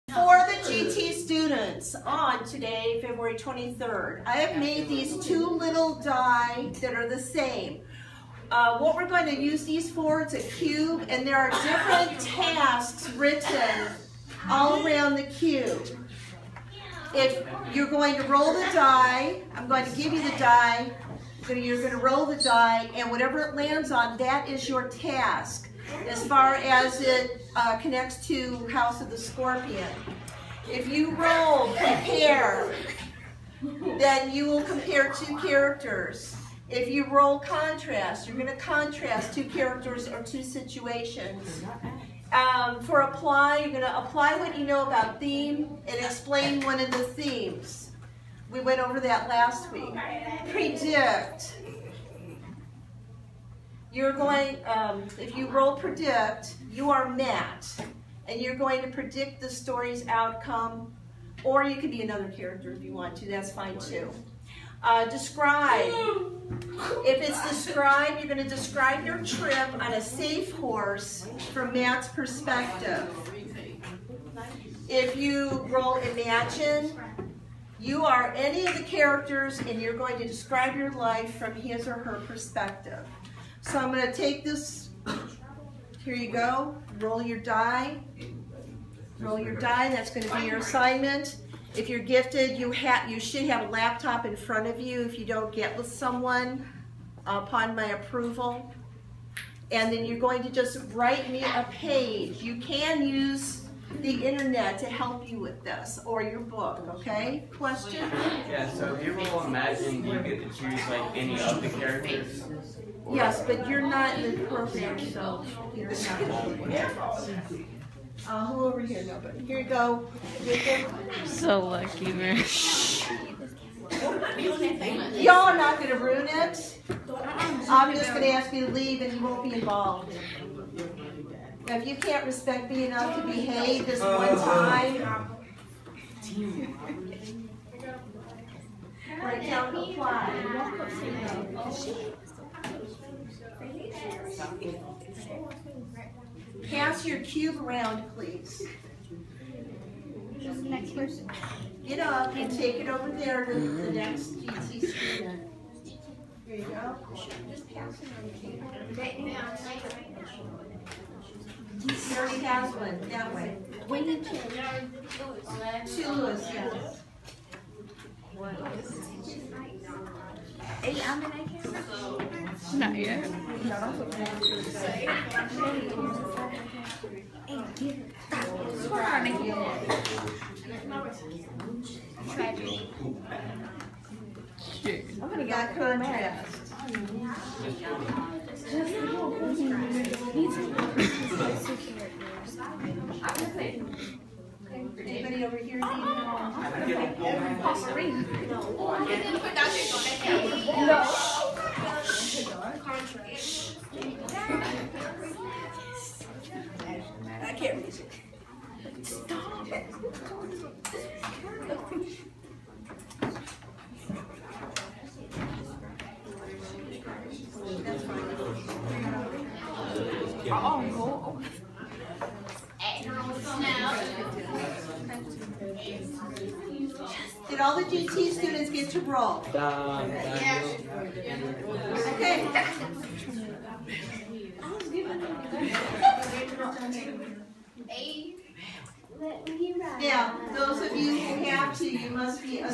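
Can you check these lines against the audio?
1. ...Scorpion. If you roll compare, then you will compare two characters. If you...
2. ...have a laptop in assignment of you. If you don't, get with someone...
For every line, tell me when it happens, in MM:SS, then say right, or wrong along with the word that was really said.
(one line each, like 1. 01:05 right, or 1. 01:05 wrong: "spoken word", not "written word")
1. 00:29 right
2. 01:33 wrong: "front", not "assignment".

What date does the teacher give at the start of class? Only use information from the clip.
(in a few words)
February 23rd.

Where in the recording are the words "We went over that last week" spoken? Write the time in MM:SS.
00:48.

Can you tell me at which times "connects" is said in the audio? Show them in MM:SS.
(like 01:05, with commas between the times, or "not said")
00:27.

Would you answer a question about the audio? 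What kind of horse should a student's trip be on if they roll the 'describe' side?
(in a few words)
A safe horse.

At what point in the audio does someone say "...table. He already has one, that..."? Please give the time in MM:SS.
02:38.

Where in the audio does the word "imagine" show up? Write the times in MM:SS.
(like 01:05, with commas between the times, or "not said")
01:15, 01:49.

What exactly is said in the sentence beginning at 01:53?
Yes, but you're not in the program, so you're not.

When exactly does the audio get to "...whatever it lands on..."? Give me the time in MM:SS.
00:23.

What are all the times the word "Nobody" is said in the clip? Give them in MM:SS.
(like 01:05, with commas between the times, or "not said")
01:59.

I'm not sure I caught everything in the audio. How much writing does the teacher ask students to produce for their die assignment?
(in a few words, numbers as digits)
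A page.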